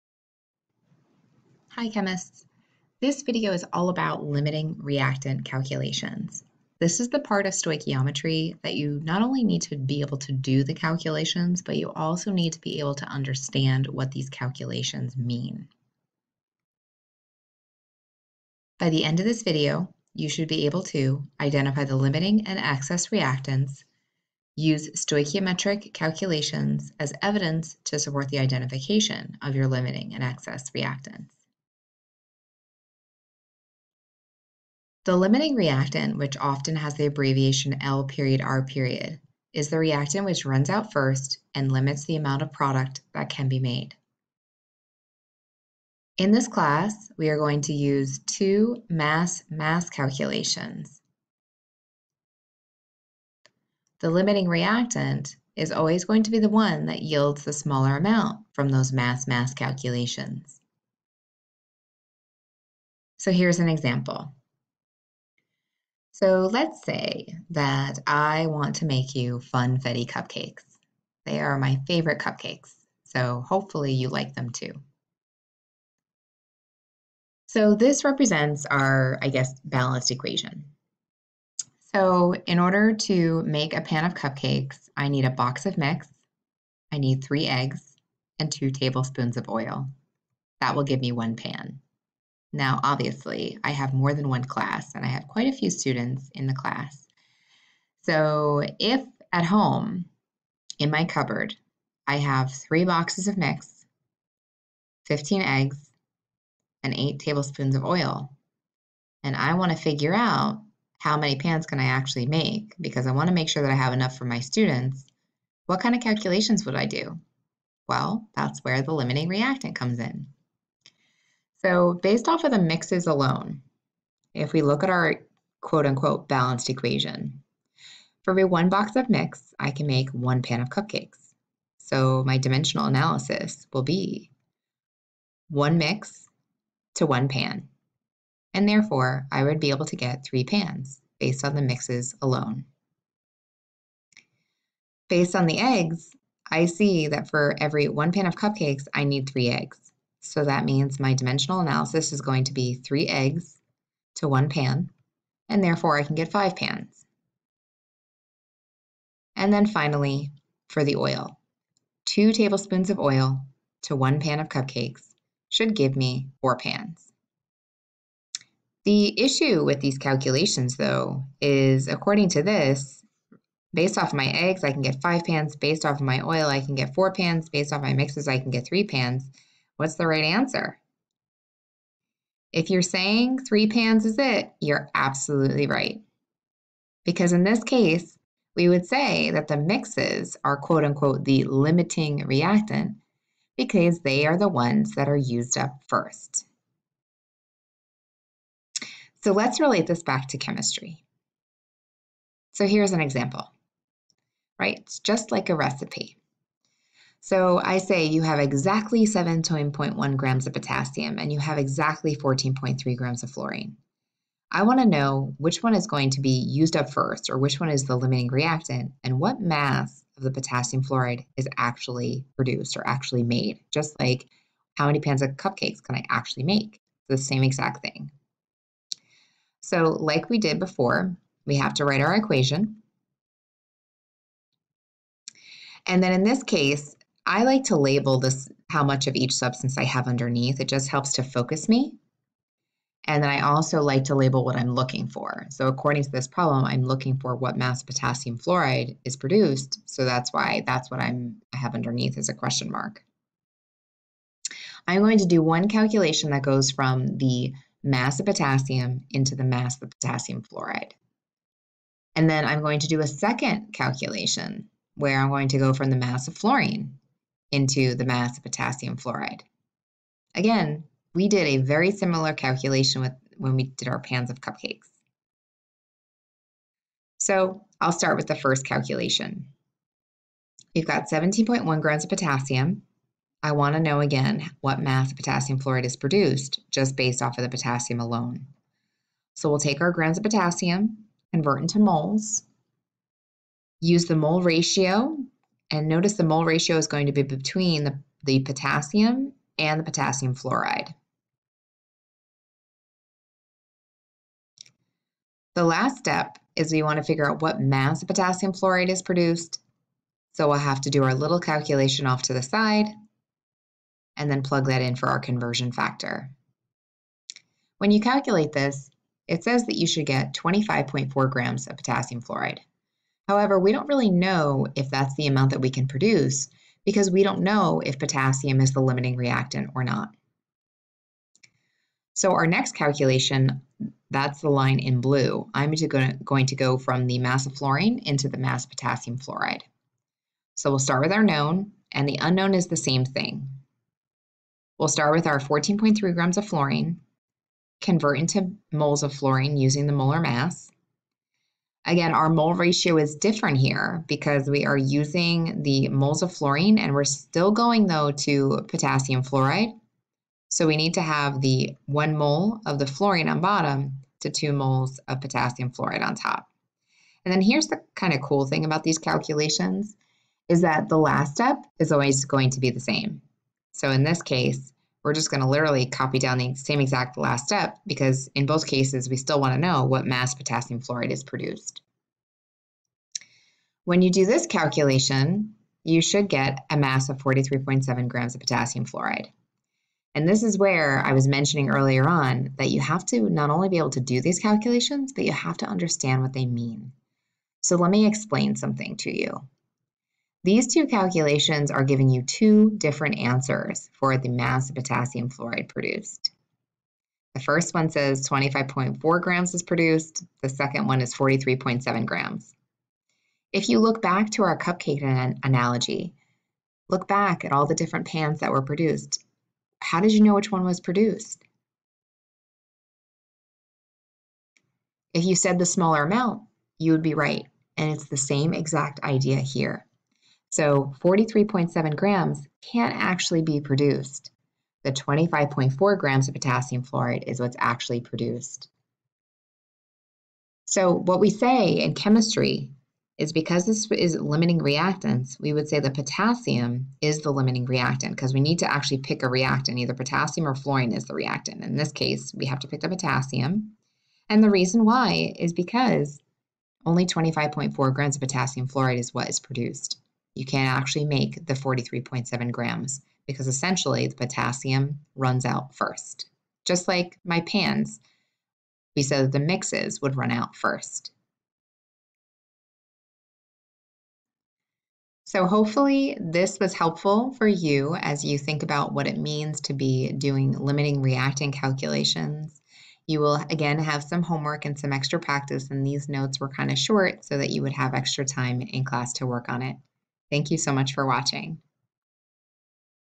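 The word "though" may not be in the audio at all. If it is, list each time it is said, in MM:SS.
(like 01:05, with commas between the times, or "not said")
02:50, 05:57.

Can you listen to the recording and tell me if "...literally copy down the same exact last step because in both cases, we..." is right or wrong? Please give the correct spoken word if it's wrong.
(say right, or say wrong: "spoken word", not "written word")
right.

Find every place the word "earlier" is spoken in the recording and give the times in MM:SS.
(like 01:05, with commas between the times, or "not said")
06:31.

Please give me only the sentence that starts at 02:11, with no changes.
So my dimensional analysis will be one mix to one pan.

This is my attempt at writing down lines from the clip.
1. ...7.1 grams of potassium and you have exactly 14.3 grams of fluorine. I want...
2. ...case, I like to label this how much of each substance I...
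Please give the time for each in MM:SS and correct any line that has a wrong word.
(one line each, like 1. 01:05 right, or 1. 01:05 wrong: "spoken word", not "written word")
1. 03:29 right
2. 03:56 right.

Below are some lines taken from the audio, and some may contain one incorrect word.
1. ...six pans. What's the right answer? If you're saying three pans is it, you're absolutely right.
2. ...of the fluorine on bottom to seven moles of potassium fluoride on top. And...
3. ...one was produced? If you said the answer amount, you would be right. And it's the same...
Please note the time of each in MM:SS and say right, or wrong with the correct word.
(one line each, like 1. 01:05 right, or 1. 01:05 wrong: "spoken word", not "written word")
1. 02:58 wrong: "three", not "six"
2. 06:02 wrong: "two", not "seven"
3. 07:00 wrong: "smaller", not "answer".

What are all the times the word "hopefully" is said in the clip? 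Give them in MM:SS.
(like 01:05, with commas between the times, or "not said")
01:13, 07:55.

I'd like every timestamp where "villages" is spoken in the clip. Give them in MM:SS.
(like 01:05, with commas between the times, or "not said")
not said.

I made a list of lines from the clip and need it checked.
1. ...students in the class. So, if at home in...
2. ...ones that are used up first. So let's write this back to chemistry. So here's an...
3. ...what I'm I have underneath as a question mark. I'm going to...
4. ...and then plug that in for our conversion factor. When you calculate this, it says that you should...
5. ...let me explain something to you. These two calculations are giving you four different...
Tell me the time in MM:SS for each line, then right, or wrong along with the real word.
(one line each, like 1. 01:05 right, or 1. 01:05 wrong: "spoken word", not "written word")
1. 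01:35 right
2. 03:14 wrong: "relate", not "write"
3. 04:10 right
4. 05:14 right
5. 06:37 wrong: "two", not "four".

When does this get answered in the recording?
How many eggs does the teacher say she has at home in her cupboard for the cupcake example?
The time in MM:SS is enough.
01:45.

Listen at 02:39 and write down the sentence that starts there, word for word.
And then finally, for the oil, two tablespoons of oil to one pan of cupcakes should give me four pans.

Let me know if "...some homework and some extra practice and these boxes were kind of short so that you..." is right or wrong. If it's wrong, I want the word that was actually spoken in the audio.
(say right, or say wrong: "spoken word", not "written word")
wrong: "notes", not "boxes".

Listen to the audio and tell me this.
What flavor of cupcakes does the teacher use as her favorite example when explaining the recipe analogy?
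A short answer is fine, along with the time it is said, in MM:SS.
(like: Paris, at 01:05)
Funfetti, at 01:09.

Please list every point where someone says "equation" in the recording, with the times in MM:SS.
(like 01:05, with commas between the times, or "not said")
01:20, 02:06, 03:52.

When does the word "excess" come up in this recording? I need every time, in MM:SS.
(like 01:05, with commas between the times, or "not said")
00:22, 00:30.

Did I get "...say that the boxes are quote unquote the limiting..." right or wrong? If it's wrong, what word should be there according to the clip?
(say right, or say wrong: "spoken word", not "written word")
wrong: "mixes", not "boxes".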